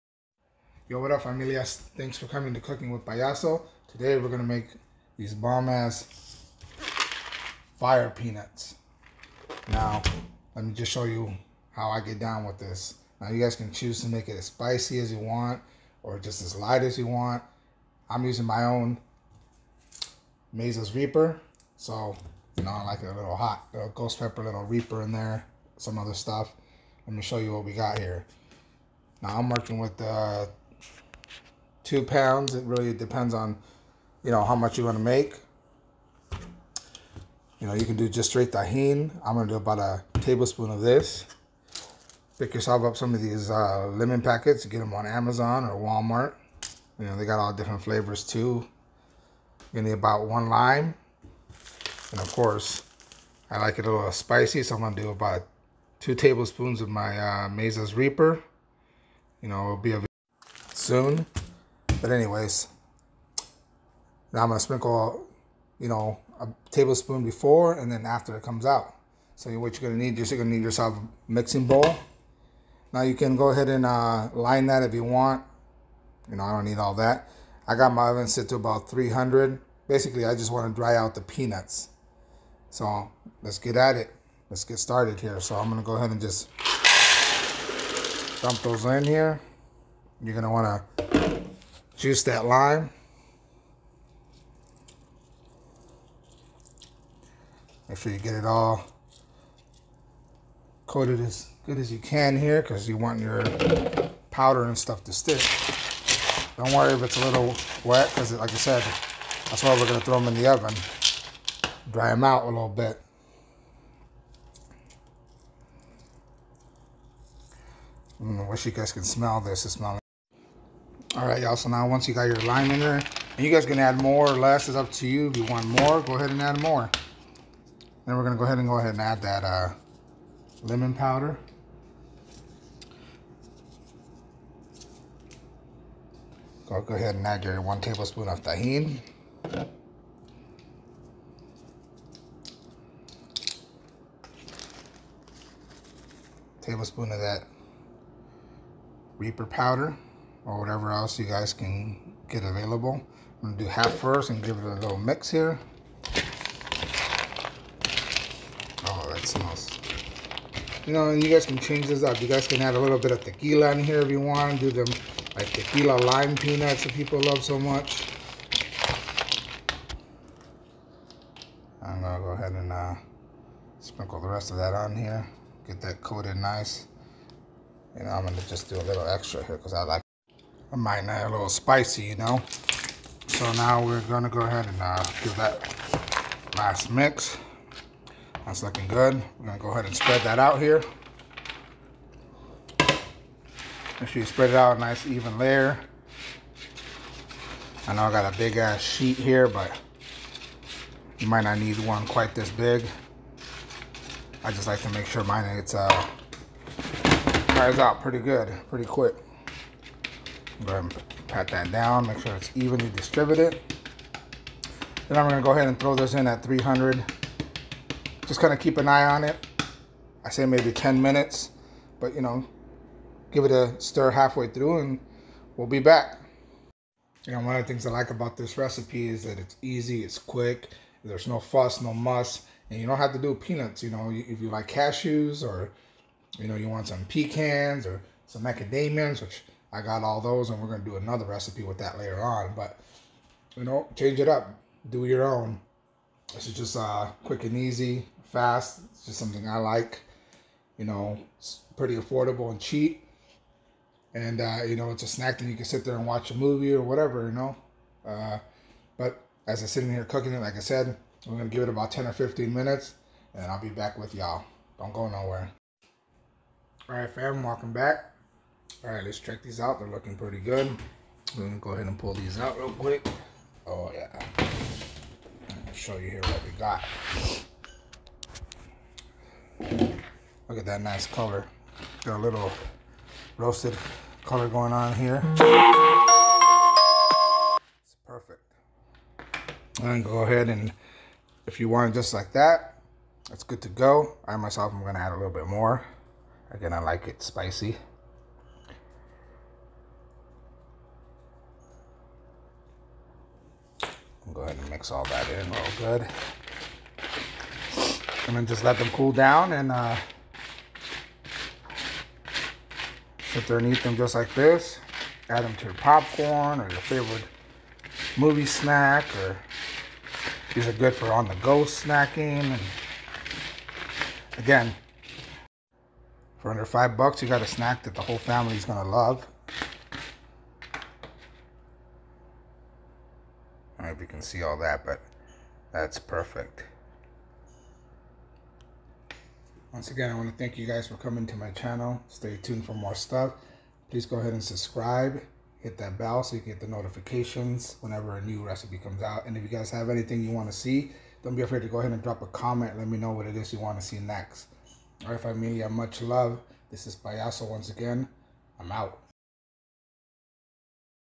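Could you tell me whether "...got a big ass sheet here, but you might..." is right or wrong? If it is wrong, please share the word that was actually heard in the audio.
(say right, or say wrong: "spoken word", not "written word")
right.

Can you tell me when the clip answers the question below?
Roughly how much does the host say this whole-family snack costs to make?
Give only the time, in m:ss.
5:26.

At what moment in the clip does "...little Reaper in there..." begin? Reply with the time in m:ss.
0:24.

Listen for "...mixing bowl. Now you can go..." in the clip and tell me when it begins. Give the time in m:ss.
1:11.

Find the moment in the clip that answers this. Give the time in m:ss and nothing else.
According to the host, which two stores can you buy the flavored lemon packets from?
0:45.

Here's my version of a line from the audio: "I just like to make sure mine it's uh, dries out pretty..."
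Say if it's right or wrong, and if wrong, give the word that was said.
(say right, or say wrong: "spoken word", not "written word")
right.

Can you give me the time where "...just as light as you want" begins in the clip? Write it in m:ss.
0:16.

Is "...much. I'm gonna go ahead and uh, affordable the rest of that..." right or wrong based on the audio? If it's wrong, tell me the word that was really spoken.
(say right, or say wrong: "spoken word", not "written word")
wrong: "sprinkle", not "affordable".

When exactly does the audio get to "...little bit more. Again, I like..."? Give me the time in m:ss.
4:55.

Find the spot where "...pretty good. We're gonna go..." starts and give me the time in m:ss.
4:30.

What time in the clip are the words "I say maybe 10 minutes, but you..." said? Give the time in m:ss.
3:40.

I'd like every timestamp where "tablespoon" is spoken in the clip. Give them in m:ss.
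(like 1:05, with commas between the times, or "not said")
0:40, 0:56, 1:06, 2:17, 2:26.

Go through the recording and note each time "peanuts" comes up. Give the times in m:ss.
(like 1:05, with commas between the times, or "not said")
0:08, 1:21, 2:46, 3:53.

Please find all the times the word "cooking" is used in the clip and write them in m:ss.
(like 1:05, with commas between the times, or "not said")
0:02, 4:20.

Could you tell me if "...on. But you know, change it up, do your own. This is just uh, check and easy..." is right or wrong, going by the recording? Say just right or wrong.
wrong.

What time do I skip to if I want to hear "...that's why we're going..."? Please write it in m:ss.
1:49.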